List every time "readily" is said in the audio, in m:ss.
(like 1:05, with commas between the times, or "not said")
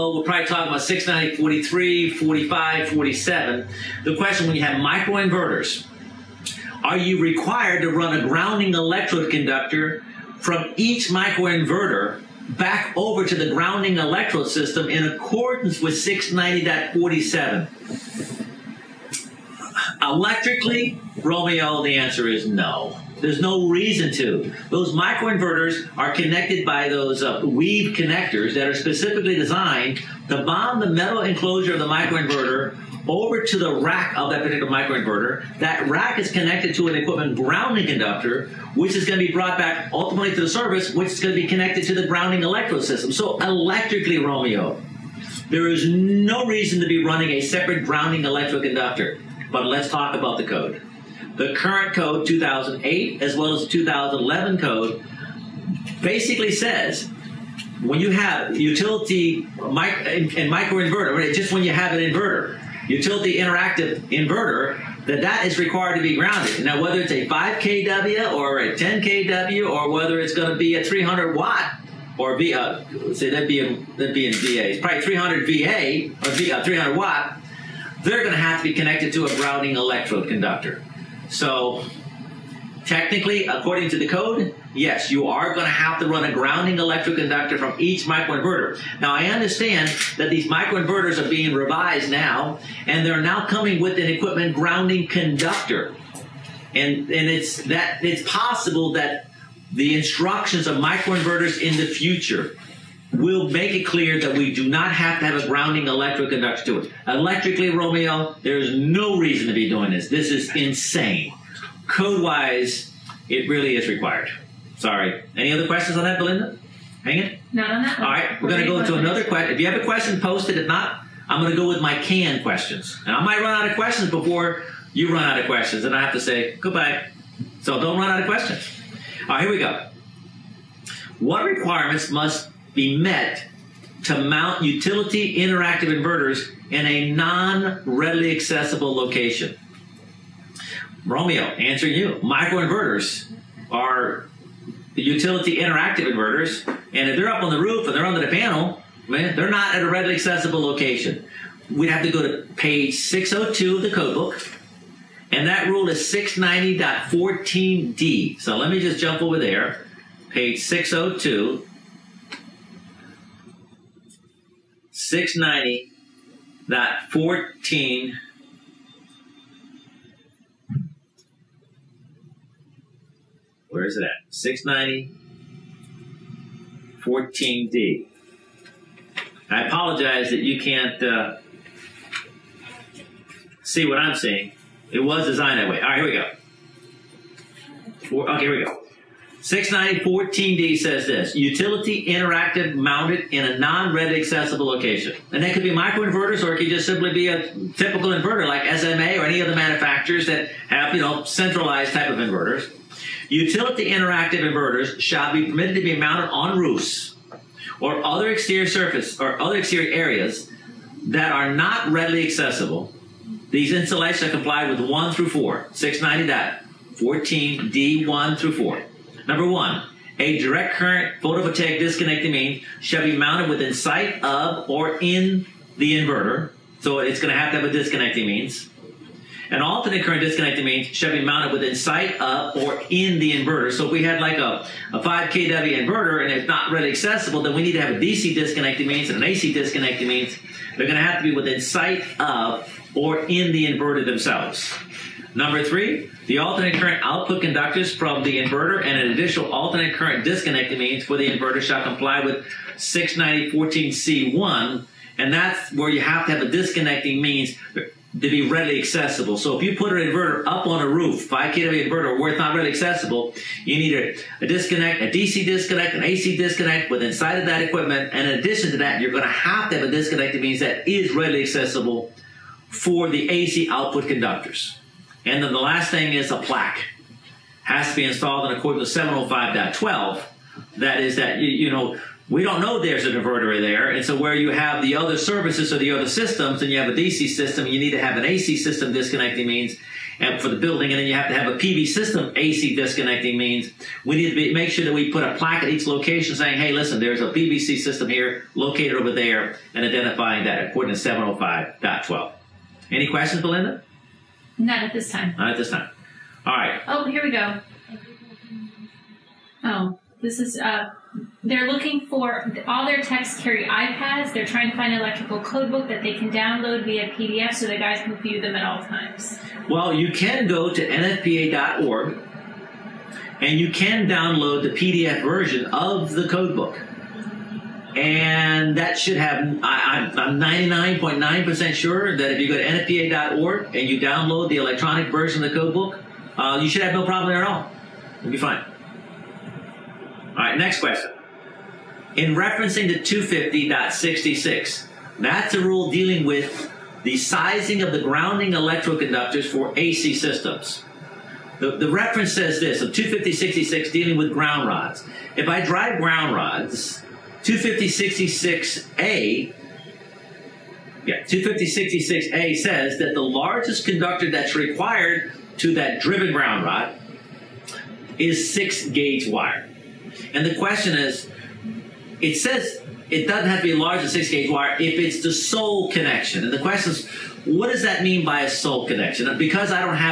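2:17, 2:29, 3:31, 4:18, 4:22, 4:31.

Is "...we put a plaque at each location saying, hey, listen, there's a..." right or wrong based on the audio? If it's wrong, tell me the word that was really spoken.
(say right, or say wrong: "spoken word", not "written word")
right.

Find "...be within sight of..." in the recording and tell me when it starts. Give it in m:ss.
4:01.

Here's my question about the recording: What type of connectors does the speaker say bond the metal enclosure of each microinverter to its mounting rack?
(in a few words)
WEEB connectors.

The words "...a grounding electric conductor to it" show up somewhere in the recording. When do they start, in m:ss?
1:45.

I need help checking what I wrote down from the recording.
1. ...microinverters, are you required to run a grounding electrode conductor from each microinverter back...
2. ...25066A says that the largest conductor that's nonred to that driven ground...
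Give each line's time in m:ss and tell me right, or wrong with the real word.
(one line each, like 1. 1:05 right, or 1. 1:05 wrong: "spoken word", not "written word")
1. 0:04 right
2. 6:01 wrong: "required", not "nonred".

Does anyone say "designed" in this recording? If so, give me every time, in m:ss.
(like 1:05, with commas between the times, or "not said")
0:29, 3:05.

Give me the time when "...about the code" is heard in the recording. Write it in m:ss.
0:50.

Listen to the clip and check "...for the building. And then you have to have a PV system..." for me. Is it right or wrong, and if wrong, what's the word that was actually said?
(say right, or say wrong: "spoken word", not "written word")
right.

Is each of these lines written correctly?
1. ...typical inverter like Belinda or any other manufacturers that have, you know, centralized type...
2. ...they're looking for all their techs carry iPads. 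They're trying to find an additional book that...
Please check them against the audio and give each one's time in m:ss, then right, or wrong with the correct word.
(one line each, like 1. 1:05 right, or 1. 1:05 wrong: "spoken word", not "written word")
1. 3:17 wrong: "SMA", not "Belinda"
2. 5:11 wrong: "electrical", not "additional".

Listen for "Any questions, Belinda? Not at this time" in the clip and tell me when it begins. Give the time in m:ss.
5:02.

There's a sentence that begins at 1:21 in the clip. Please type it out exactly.
So technically, according to the code, yes, you are going to have to run a grounding electrode conductor from each microinverter.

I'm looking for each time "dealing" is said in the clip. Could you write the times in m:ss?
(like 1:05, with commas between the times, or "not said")
5:45, 5:53.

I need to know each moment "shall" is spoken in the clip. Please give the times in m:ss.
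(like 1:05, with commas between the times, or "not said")
3:24, 3:42, 3:50, 4:11.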